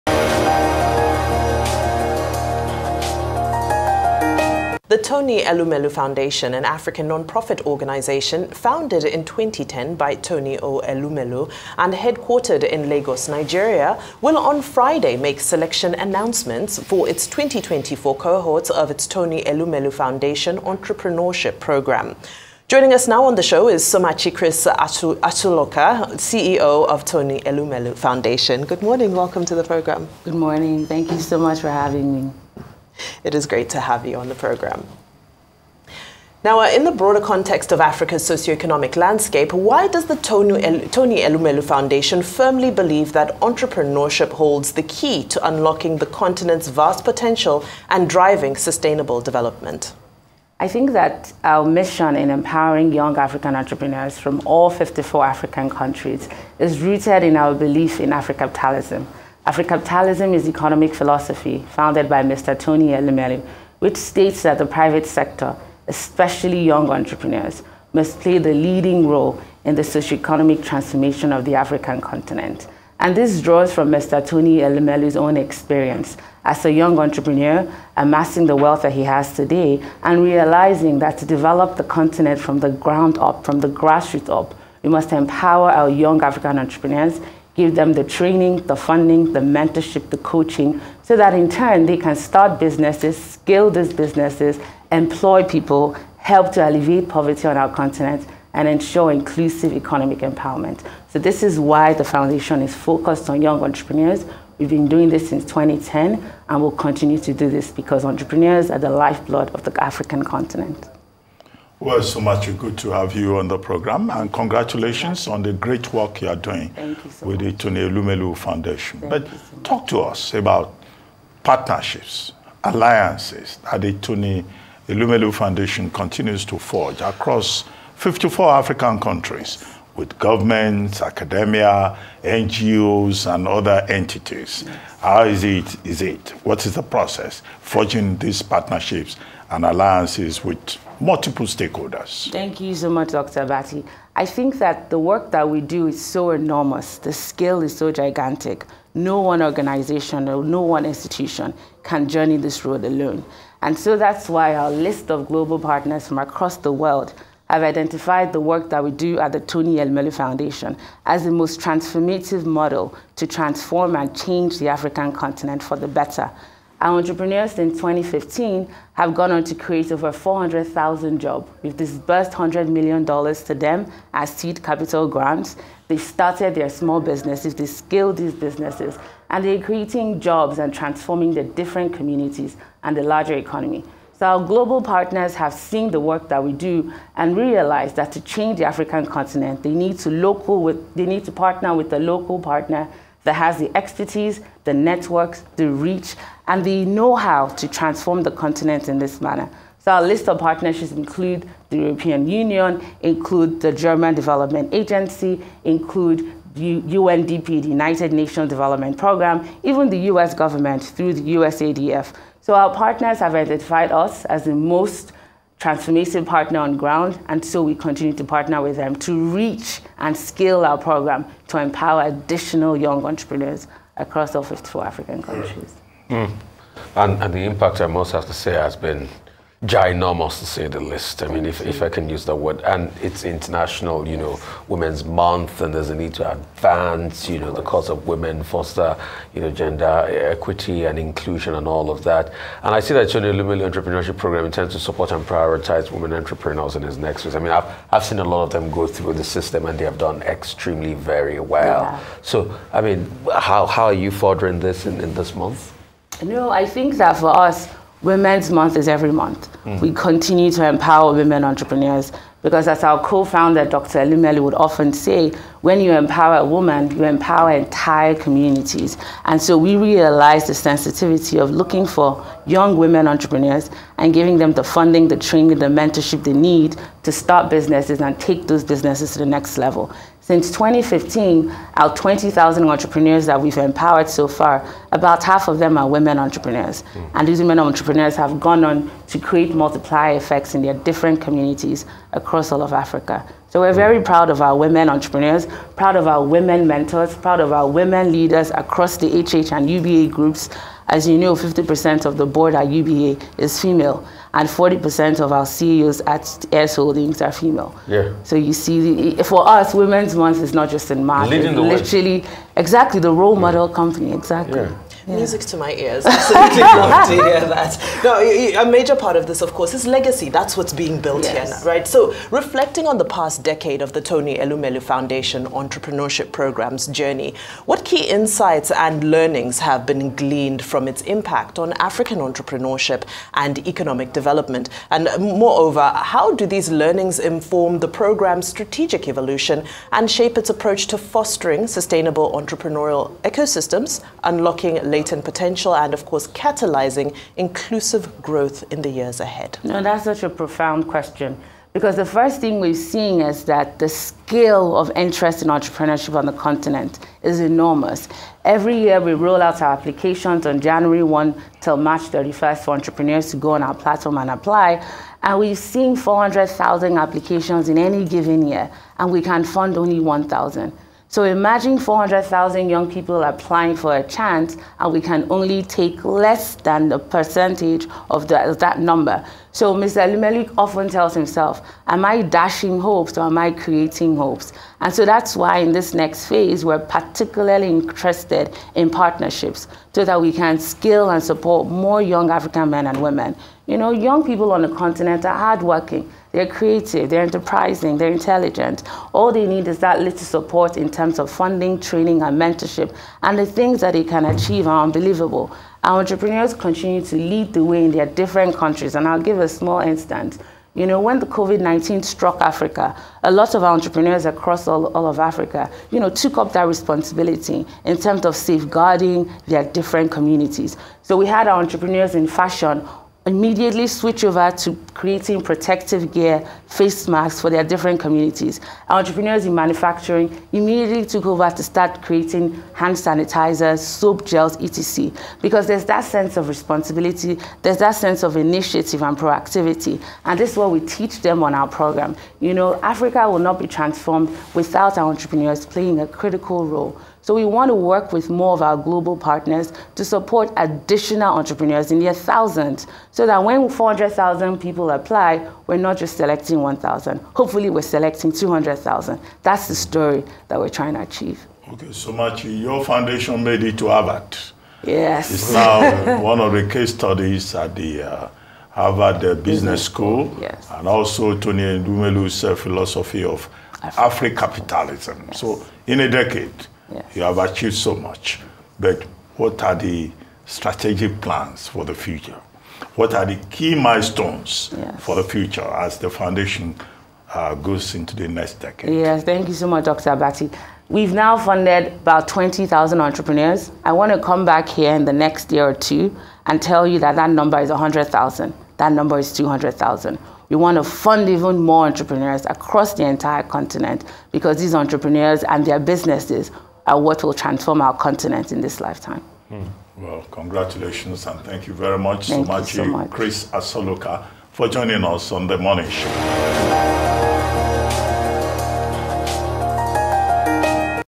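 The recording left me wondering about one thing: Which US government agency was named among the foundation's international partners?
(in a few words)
USADF.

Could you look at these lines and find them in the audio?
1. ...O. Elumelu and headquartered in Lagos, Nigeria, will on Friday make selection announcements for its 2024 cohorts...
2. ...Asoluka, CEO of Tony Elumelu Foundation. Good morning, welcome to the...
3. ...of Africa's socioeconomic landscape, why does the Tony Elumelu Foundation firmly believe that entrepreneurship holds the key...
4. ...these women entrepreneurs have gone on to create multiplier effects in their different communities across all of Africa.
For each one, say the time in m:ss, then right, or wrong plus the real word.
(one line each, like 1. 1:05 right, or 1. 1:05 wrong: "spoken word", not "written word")
1. 0:10 right
2. 0:24 right
3. 0:37 right
4. 4:47 right.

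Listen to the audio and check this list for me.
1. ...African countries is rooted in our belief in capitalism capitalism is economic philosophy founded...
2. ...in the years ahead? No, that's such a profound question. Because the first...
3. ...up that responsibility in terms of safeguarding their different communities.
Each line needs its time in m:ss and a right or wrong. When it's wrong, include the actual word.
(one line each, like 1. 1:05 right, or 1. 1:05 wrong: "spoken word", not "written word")
1. 0:55 right
2. 5:48 right
3. 6:56 right.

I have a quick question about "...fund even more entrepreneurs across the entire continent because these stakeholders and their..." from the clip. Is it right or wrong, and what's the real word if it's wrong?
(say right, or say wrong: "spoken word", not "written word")
wrong: "entrepreneurs", not "stakeholders".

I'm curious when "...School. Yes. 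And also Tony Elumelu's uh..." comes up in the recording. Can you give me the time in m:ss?
7:49.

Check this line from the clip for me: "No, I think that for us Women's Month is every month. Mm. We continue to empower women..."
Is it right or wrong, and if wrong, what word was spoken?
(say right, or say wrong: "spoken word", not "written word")
right.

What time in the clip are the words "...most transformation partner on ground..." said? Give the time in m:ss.
3:34.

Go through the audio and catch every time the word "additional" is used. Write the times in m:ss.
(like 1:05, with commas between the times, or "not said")
3:42, 7:30.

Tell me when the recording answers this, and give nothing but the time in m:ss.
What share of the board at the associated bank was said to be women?
5:01.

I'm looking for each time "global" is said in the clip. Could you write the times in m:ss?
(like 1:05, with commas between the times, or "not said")
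2:35, 3:04, 7:28.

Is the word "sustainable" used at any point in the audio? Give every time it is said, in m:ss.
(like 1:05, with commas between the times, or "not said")
0:48, 5:41.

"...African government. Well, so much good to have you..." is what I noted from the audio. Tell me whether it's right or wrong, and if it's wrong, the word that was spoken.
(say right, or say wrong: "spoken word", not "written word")
wrong: "continent", not "government".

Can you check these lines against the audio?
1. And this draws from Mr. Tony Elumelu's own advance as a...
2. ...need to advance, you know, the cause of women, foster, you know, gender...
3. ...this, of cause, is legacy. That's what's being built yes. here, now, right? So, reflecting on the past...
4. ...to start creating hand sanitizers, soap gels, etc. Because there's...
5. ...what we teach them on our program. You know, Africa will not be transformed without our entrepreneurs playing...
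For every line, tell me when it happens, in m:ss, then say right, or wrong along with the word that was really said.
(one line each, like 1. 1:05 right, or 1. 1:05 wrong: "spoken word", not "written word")
1. 1:12 wrong: "experience", not "advance"
2. 3:55 right
3. 5:19 wrong: "course", not "cause"
4. 7:11 right
5. 7:20 right.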